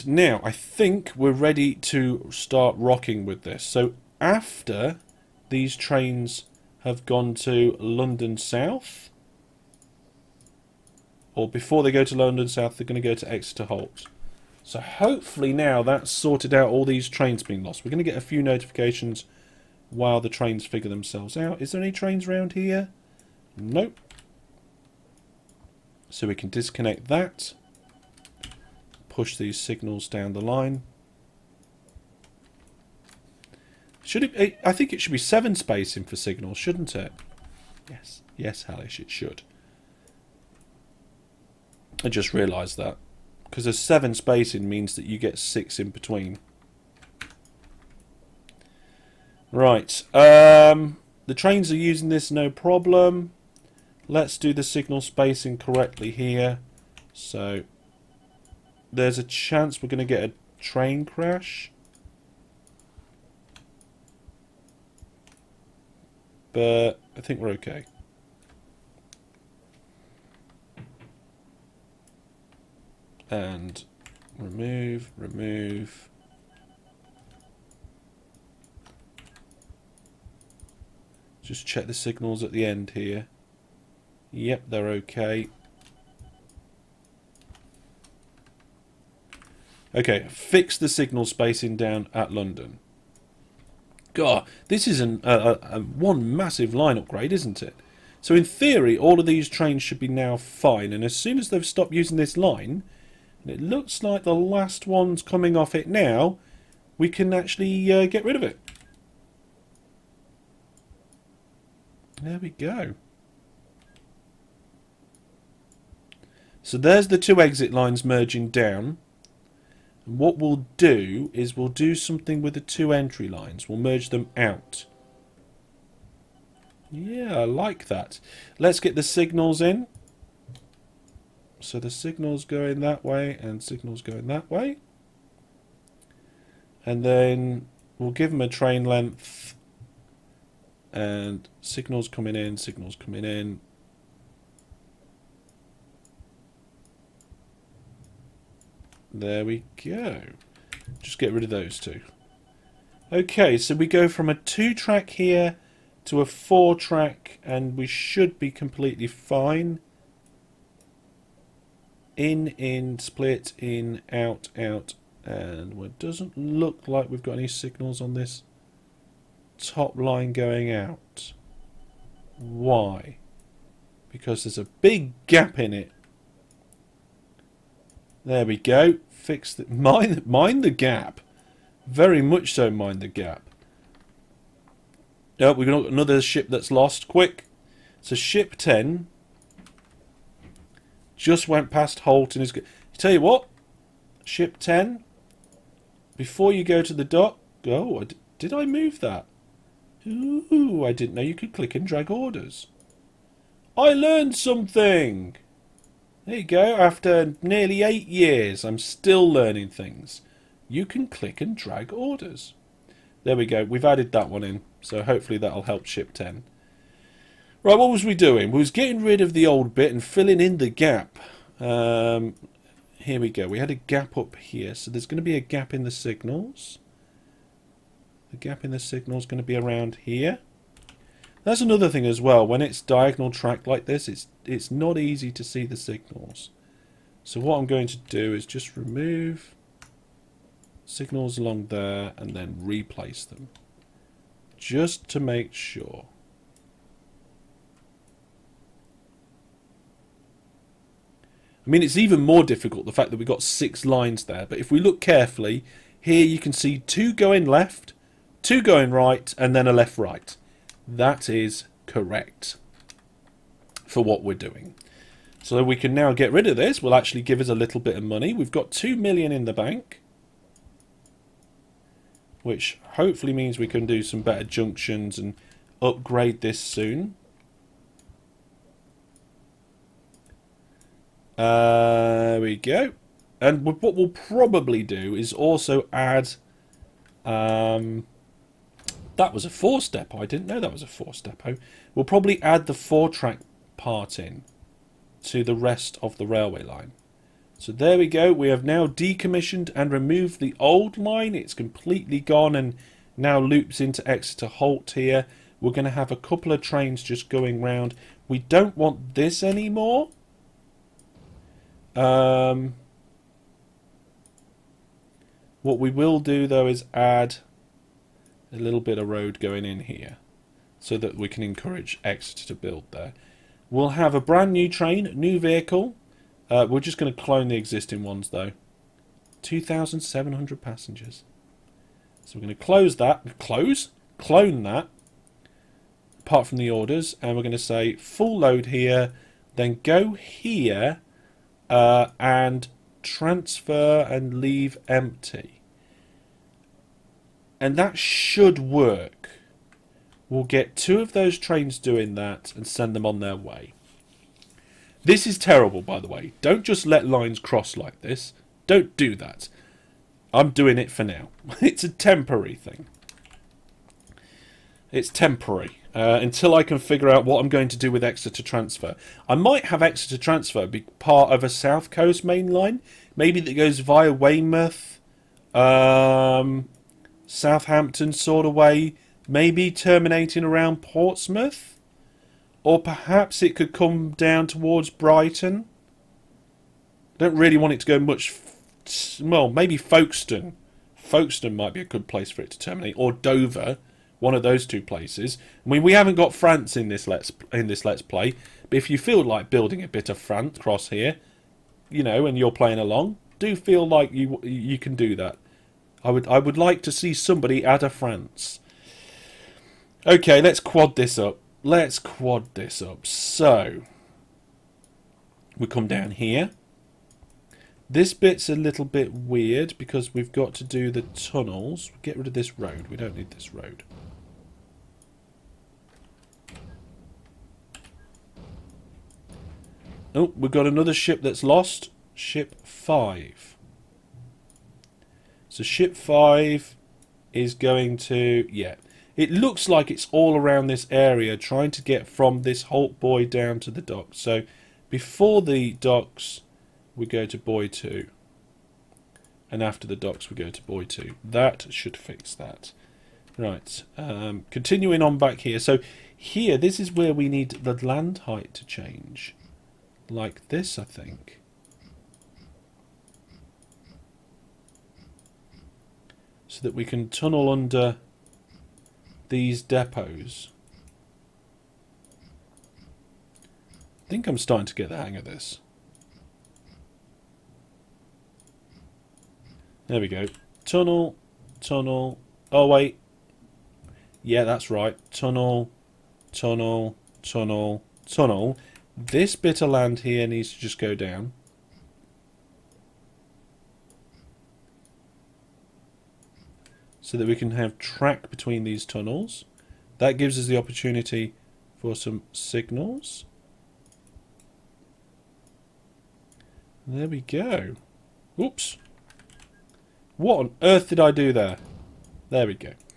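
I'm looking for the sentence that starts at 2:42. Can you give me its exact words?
In, in, split, in, out, out, and it doesn't look like we've got any signals on this top line going out.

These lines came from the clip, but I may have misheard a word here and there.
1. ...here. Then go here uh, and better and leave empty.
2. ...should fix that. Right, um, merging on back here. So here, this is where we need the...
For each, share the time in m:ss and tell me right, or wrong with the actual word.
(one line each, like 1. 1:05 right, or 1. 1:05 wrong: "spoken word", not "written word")
1. 5:38 wrong: "transfer", not "better"
2. 7:31 wrong: "continuing", not "merging".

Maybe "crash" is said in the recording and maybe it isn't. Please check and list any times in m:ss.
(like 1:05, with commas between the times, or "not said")
1:01.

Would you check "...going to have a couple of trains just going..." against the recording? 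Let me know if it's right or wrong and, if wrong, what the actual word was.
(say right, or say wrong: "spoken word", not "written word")
right.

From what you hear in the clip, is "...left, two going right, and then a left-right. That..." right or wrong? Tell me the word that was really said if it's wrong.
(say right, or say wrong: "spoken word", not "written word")
right.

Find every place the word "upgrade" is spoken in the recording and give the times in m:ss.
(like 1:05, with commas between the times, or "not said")
1:36, 4:35.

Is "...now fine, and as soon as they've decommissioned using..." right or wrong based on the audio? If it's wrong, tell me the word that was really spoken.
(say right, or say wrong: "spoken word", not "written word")
wrong: "stopped", not "decommissioned".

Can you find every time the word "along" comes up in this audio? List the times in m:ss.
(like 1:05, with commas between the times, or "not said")
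4:01, 6:42.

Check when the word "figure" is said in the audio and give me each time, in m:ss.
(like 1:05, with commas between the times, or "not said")
0:20, 6:06.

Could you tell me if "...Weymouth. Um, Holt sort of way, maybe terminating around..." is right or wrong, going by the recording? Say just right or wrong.
wrong.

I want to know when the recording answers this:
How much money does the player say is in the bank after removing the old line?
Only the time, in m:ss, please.
4:28.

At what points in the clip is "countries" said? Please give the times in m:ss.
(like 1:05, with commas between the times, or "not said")
not said.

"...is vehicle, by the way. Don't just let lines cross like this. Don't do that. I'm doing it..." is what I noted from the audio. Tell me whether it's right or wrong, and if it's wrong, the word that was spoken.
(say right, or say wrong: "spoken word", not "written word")
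wrong: "terrible", not "vehicle".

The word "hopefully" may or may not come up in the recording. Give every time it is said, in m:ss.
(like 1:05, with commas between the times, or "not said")
0:14, 3:35, 4:32.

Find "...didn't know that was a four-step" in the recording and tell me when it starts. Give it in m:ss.
4:50.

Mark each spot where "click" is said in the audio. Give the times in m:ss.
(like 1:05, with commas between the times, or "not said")
3:21, 3:31.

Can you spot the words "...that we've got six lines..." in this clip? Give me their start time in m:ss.
4:13.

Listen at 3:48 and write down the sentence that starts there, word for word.
The gap in the signal is going to be around here.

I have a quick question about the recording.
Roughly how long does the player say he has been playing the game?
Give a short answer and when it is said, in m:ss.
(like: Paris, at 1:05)
nearly eight years, at 3:27.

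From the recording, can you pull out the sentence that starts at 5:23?
We'll have a brand new train, new vehicle.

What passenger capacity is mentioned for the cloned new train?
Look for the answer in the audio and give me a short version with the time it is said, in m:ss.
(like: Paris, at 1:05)
2,700, at 5:29.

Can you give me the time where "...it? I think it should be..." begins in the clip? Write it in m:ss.
0:34.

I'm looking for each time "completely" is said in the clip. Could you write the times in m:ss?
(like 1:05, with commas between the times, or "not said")
2:38, 5:01.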